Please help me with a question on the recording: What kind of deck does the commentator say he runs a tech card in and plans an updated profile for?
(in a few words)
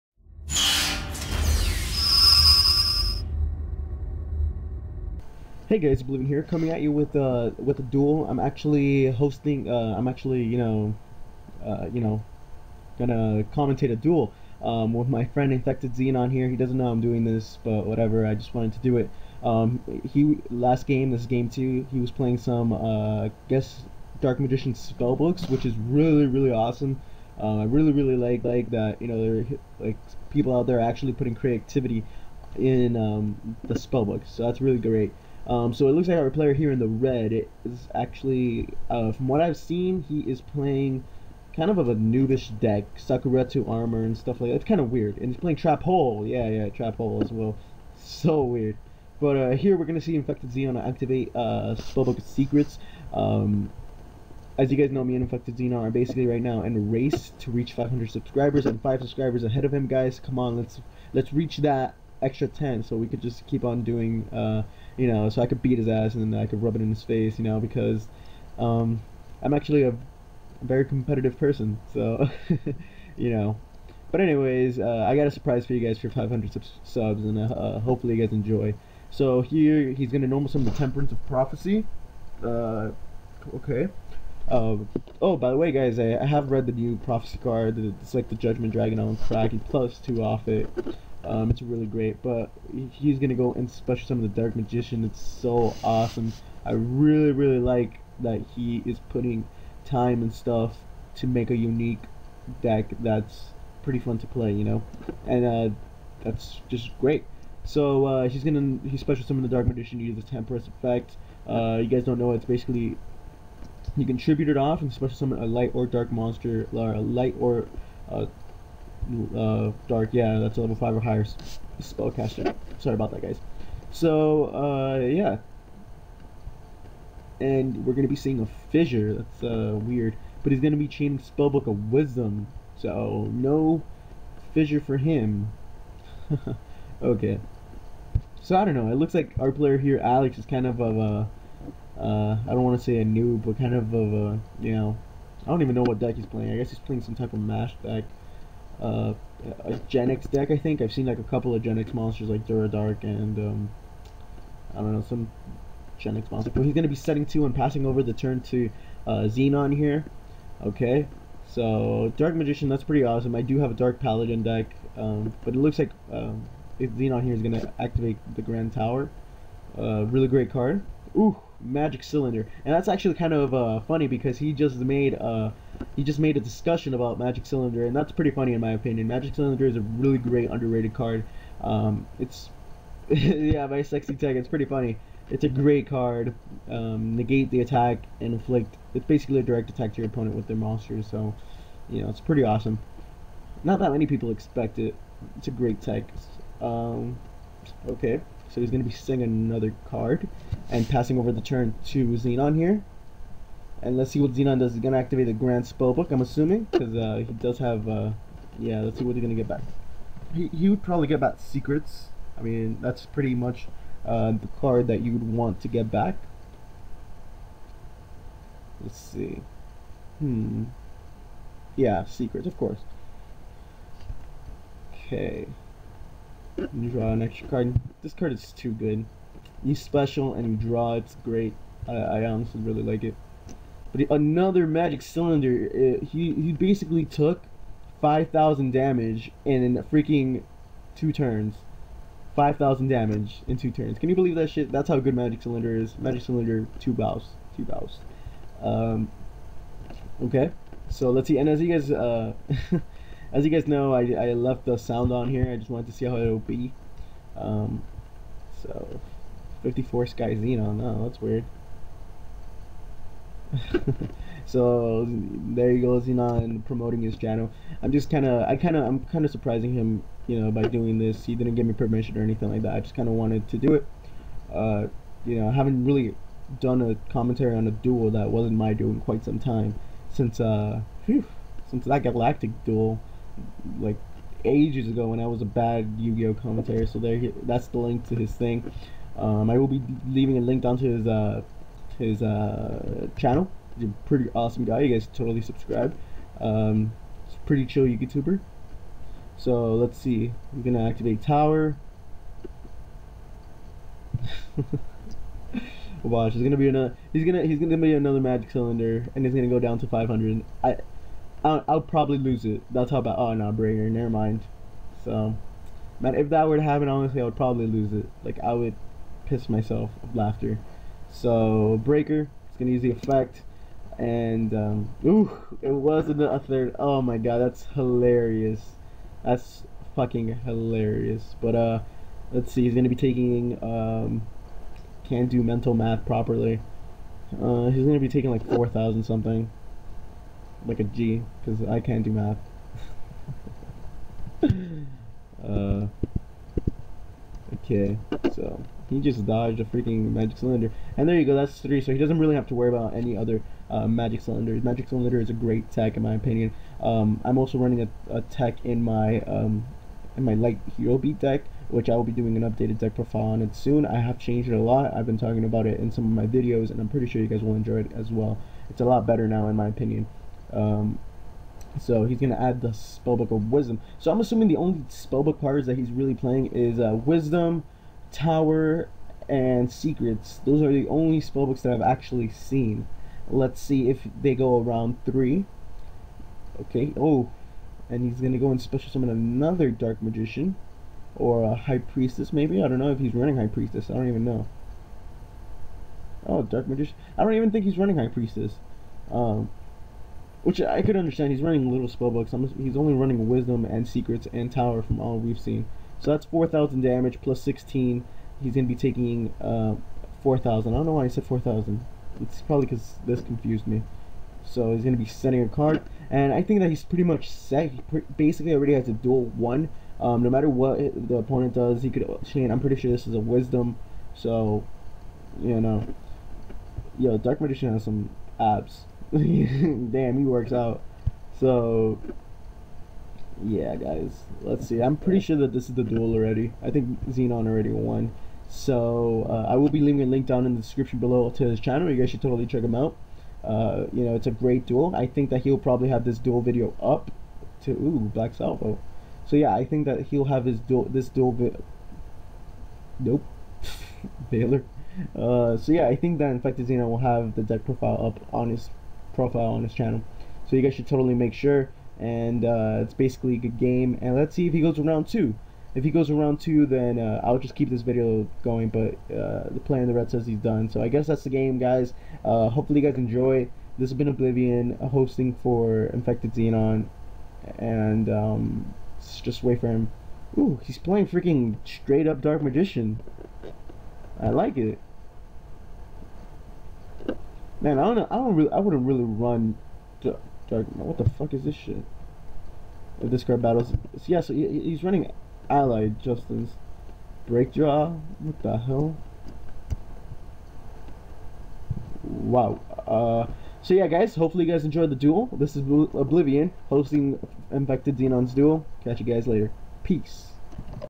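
light hero beat deck.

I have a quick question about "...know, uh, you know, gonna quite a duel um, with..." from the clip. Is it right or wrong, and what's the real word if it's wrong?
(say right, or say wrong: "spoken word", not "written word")
wrong: "commentate", not "quite".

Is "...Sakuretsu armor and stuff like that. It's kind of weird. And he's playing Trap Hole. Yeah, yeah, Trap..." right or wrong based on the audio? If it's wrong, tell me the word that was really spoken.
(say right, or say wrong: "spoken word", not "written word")
right.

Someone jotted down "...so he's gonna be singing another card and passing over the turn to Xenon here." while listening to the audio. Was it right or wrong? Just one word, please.
right.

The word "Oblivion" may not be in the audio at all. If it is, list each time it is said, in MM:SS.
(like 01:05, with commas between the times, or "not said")
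00:06, 07:54, 08:25.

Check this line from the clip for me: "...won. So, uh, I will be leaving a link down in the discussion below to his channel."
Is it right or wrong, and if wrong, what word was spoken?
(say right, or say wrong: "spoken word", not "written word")
wrong: "description", not "discussion".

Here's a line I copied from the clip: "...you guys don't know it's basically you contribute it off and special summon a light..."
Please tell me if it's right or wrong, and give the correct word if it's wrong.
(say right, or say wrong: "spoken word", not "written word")
right.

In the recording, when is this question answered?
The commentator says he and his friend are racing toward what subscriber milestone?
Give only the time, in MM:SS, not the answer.
00:57.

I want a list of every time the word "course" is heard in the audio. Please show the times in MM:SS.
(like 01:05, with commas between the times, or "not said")
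03:42.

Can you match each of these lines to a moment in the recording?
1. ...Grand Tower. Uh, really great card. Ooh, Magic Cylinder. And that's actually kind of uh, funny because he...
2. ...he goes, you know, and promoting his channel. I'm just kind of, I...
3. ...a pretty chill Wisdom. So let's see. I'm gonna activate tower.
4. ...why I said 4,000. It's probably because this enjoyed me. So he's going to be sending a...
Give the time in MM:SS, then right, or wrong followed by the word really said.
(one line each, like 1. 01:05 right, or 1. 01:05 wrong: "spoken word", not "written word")
1. 02:48 right
2. 04:25 right
3. 04:57 wrong: "YouTuber", not "Wisdom"
4. 06:50 wrong: "confused", not "enjoyed".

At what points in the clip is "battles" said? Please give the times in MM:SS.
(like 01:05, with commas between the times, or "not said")
08:13.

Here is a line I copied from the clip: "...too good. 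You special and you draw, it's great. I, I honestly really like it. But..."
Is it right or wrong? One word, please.
right.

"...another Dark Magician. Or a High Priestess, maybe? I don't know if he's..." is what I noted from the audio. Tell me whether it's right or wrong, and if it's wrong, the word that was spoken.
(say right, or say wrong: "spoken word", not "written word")
right.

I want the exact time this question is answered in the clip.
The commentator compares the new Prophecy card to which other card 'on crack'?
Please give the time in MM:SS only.
01:28.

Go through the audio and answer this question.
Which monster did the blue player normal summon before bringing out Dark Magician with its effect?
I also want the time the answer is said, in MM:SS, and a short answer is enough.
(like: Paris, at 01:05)
Temperance of Prophecy, at 01:20.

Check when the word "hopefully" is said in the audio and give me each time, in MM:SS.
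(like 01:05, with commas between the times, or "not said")
01:17, 07:52, 08:24.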